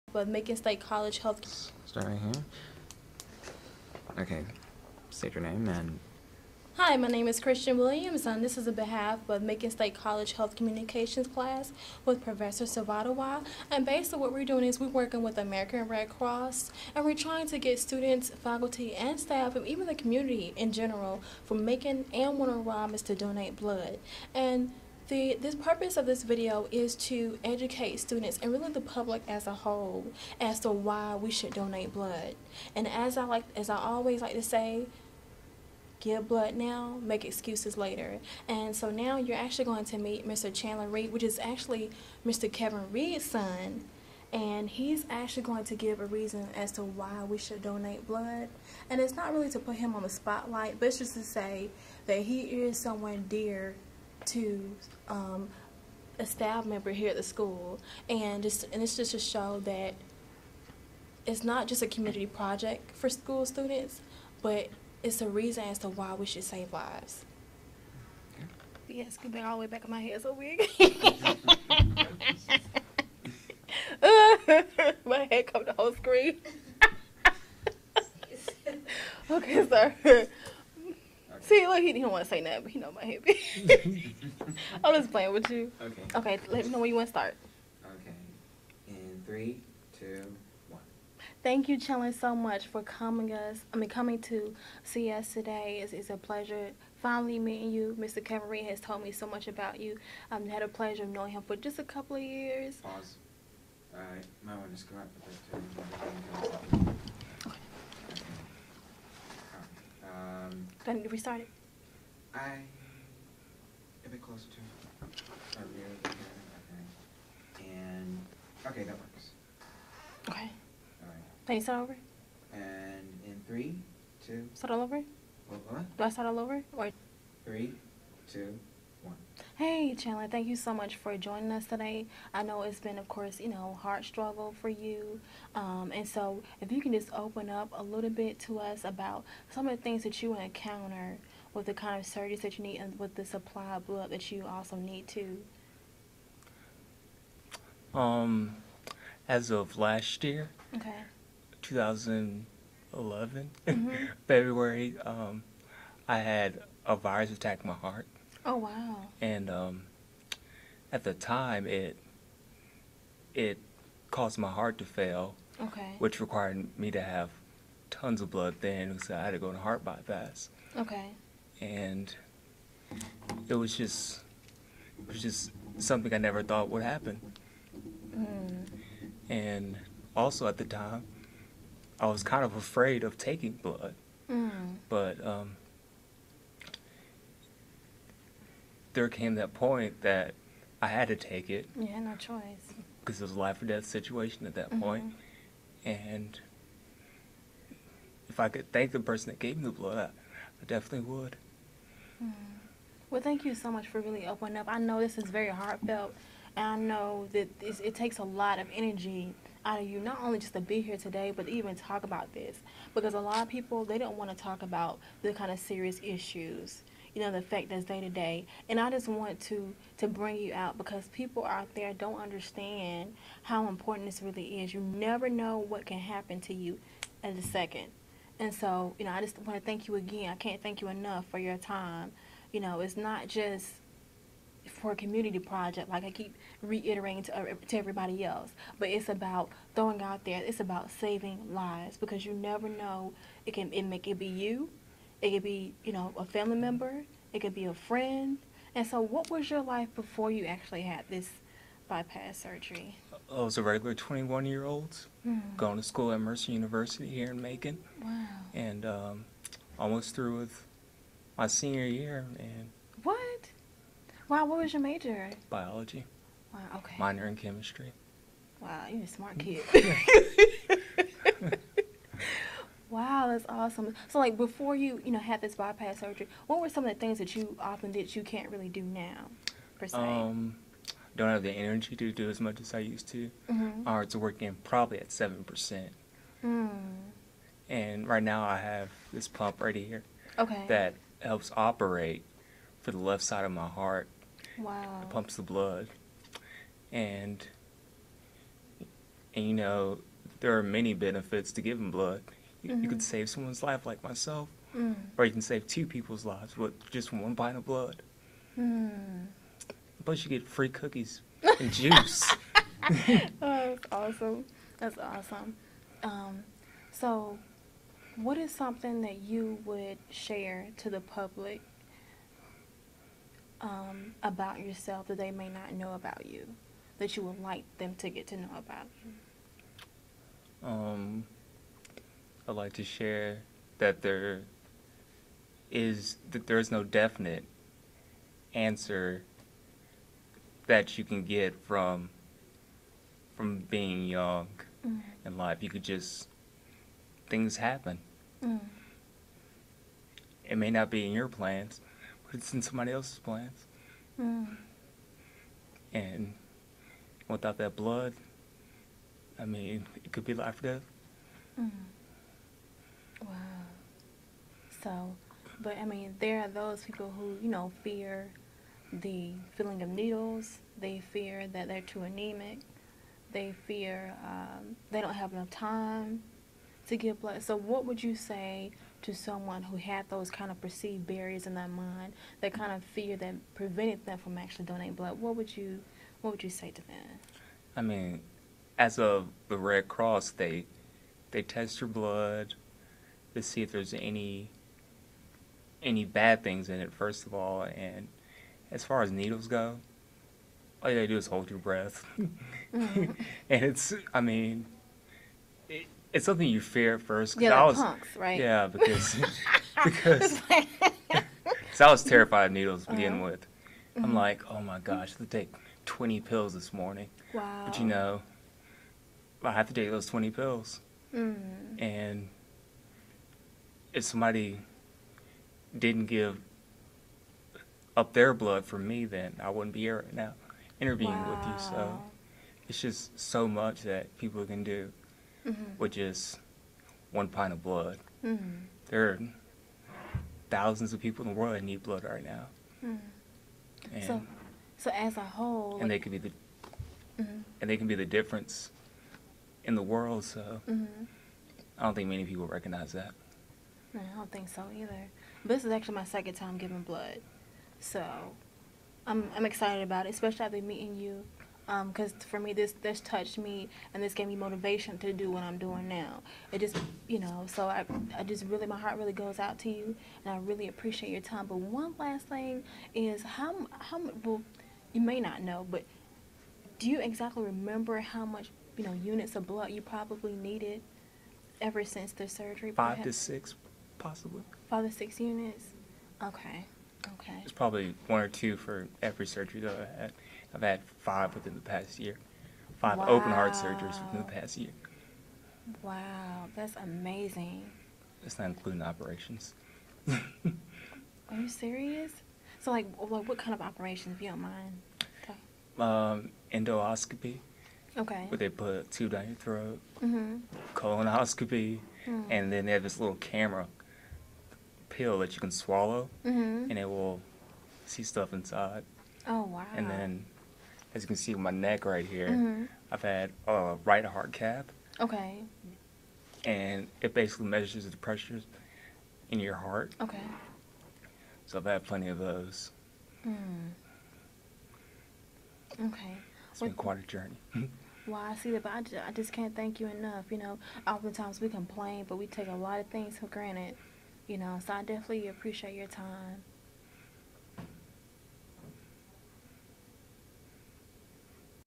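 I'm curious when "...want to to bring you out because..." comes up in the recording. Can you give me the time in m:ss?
3:39.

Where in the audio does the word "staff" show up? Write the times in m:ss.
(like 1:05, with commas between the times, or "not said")
0:19, 0:56.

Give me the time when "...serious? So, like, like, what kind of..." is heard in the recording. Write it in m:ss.
8:21.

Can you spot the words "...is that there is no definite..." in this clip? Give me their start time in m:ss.
5:35.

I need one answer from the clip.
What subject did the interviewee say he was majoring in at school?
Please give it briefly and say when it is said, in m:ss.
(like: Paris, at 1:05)
Biology, at 4:25.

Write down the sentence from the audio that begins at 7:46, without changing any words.
It just, you know, so I, I just really, my heart really goes out to you and I really appreciate your time.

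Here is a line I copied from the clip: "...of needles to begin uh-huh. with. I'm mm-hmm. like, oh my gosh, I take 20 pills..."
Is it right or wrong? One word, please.
right.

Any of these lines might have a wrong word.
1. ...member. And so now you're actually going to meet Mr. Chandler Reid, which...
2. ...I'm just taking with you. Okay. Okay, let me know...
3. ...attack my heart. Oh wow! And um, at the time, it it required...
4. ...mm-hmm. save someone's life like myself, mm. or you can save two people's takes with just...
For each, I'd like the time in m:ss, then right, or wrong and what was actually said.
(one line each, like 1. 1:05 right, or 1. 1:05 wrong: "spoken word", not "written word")
1. 0:37 wrong: "later", not "member"
2. 1:24 wrong: "playing", not "taking"
3. 2:37 wrong: "caused", not "required"
4. 5:02 wrong: "lives", not "takes".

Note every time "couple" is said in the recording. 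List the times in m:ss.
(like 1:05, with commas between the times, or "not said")
1:41.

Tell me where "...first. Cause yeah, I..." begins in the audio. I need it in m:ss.
6:47.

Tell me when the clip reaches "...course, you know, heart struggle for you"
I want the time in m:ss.
2:13.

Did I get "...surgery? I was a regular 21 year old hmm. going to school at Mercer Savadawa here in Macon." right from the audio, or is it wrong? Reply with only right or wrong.
wrong.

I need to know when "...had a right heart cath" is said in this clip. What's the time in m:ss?
8:43.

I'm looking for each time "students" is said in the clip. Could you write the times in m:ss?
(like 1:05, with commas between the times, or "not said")
0:17, 0:27, 1:03.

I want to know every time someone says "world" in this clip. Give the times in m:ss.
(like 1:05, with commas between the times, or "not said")
7:21, 7:29.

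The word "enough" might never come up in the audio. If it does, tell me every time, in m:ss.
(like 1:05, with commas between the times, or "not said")
3:50, 6:15, 8:59.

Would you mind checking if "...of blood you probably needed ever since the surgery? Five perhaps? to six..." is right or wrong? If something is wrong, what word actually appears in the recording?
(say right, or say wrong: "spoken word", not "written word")
right.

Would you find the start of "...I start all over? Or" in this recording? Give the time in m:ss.
2:06.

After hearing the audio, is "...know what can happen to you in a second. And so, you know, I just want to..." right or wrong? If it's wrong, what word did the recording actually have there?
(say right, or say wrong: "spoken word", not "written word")
right.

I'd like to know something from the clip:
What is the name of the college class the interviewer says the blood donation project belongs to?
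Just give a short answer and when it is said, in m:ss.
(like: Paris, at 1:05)
Health Communications, at 0:10.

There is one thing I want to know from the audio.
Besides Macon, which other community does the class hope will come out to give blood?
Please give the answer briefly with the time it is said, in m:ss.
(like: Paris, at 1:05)
Warner Robins, at 0:22.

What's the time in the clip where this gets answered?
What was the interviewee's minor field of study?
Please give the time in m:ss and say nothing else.
4:27.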